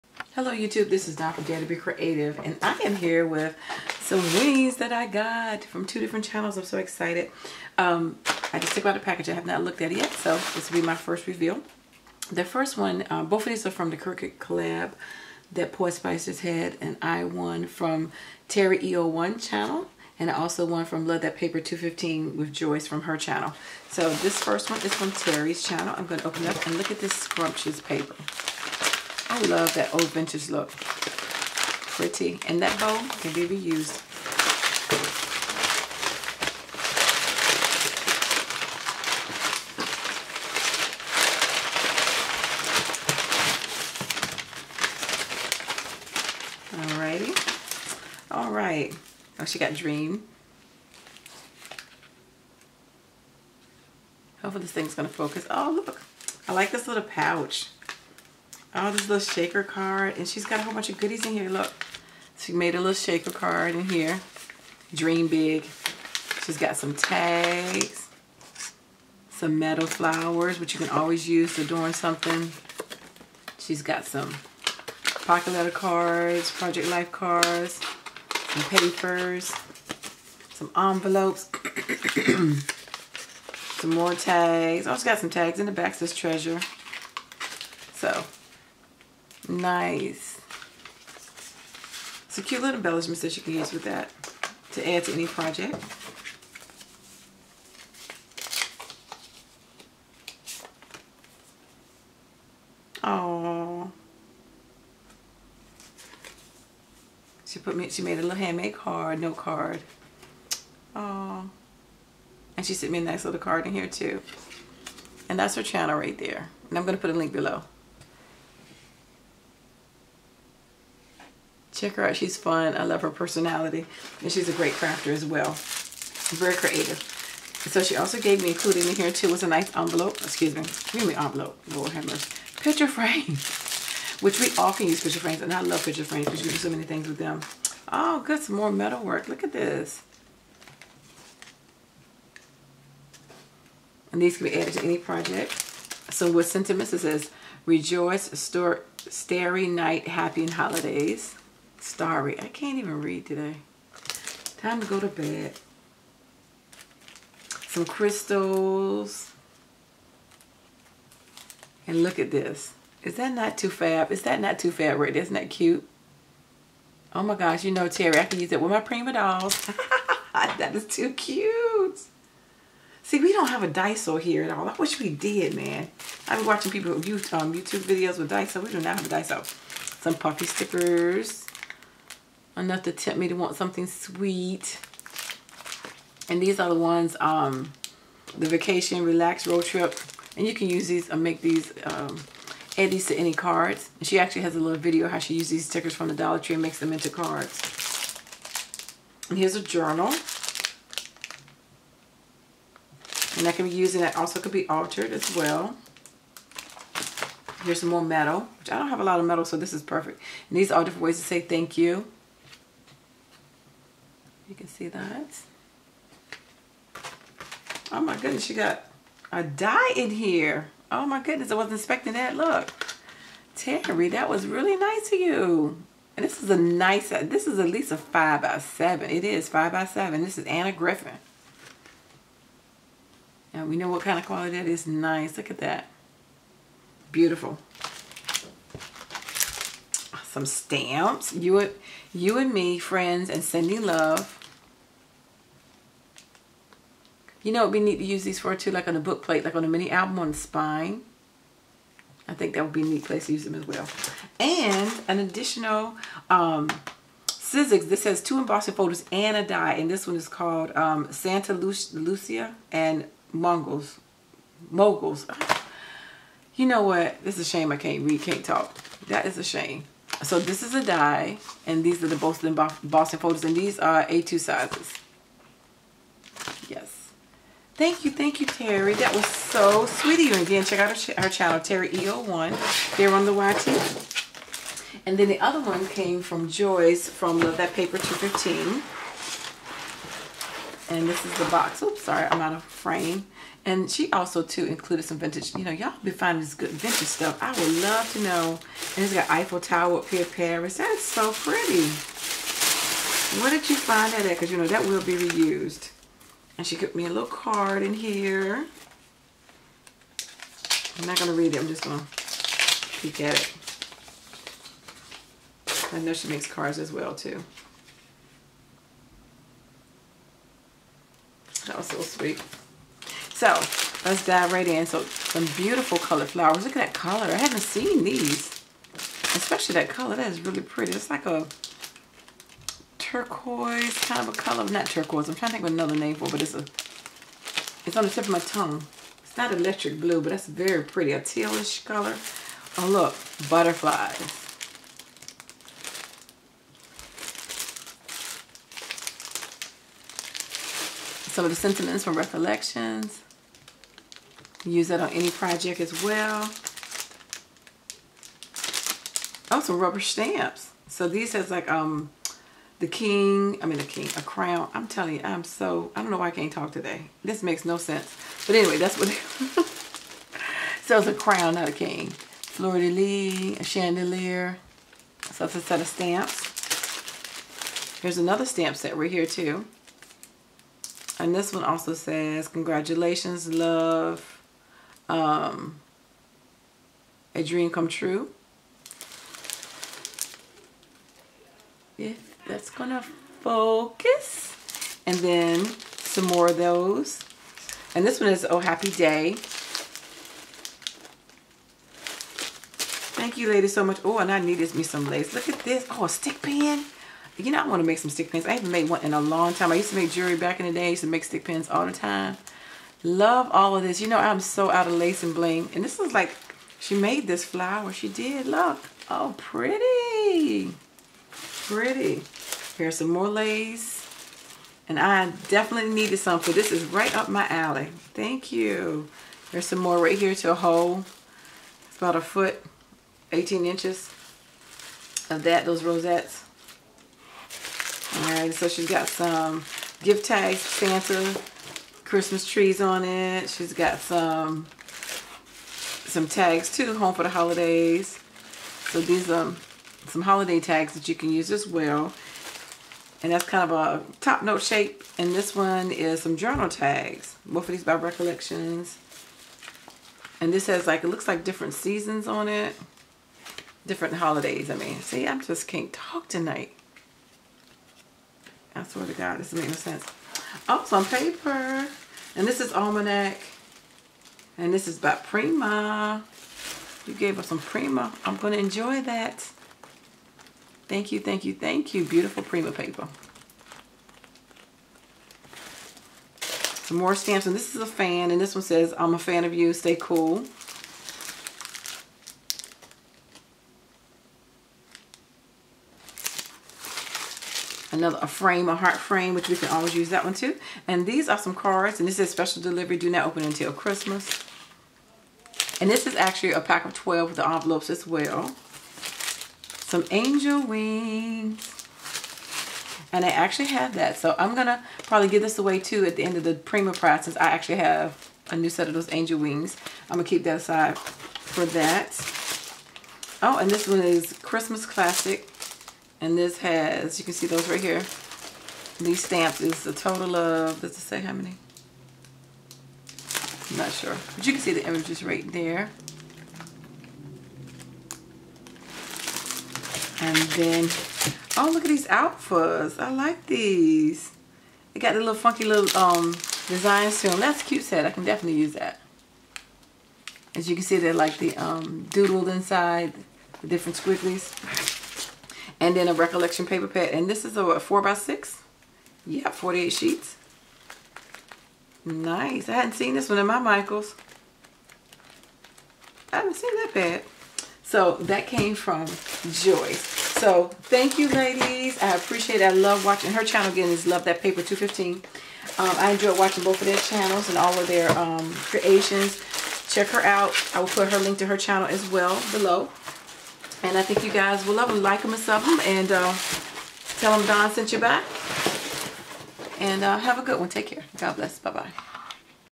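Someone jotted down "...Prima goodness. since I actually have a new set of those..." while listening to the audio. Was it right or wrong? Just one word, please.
wrong.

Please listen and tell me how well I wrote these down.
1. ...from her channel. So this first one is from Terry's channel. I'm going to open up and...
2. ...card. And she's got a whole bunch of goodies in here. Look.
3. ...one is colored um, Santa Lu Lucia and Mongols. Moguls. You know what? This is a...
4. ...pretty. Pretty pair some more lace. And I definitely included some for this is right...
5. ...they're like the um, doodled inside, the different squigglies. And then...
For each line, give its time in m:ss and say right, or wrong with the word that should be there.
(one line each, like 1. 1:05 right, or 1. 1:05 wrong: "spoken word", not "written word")
1. 0:22 right
2. 0:59 right
3. 4:20 wrong: "called", not "colored"
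4. 6:59 wrong: "needed", not "included"
5. 9:10 right.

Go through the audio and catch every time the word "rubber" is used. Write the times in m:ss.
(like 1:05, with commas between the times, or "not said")
5:59.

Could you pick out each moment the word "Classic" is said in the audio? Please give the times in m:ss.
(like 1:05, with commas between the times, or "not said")
8:44.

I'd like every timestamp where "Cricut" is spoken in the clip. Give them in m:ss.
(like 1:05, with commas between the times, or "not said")
0:13.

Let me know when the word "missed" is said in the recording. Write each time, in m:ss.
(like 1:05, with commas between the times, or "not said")
not said.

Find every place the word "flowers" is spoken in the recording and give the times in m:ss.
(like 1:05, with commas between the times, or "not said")
1:09, 5:26, 6:57.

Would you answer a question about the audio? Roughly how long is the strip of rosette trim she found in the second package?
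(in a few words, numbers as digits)
18 inches.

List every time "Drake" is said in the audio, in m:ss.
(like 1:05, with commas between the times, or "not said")
not said.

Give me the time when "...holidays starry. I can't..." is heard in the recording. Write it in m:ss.
2:30.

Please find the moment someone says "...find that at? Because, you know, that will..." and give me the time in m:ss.
5:03.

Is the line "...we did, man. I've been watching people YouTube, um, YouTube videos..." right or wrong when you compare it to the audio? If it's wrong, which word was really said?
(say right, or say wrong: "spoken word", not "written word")
right.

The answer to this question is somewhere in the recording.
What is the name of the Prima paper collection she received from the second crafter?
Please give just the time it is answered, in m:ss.
7:52.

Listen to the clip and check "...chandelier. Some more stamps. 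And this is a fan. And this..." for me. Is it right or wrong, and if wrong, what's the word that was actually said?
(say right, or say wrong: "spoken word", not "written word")
wrong: "paper", not "chandelier".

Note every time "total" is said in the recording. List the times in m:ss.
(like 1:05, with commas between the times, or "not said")
8:49.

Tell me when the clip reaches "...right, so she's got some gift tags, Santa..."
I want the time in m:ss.
7:18.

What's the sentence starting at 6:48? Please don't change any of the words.
I haven't made one in a long time.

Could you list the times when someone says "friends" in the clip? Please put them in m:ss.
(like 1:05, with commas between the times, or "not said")
4:02.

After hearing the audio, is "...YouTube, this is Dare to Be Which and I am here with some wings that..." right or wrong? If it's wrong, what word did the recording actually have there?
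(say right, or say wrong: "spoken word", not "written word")
wrong: "Creative", not "Which".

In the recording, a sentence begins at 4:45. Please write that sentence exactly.
And then the other one came from Joyce from Love That Paper 215.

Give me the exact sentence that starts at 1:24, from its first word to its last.
I oh, also got some tags in the back, says treasure.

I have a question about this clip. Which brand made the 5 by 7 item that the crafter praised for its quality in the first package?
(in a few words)
Anna Griffin.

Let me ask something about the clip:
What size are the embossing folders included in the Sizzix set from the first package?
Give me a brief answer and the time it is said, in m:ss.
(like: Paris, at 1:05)
A2, at 4:34.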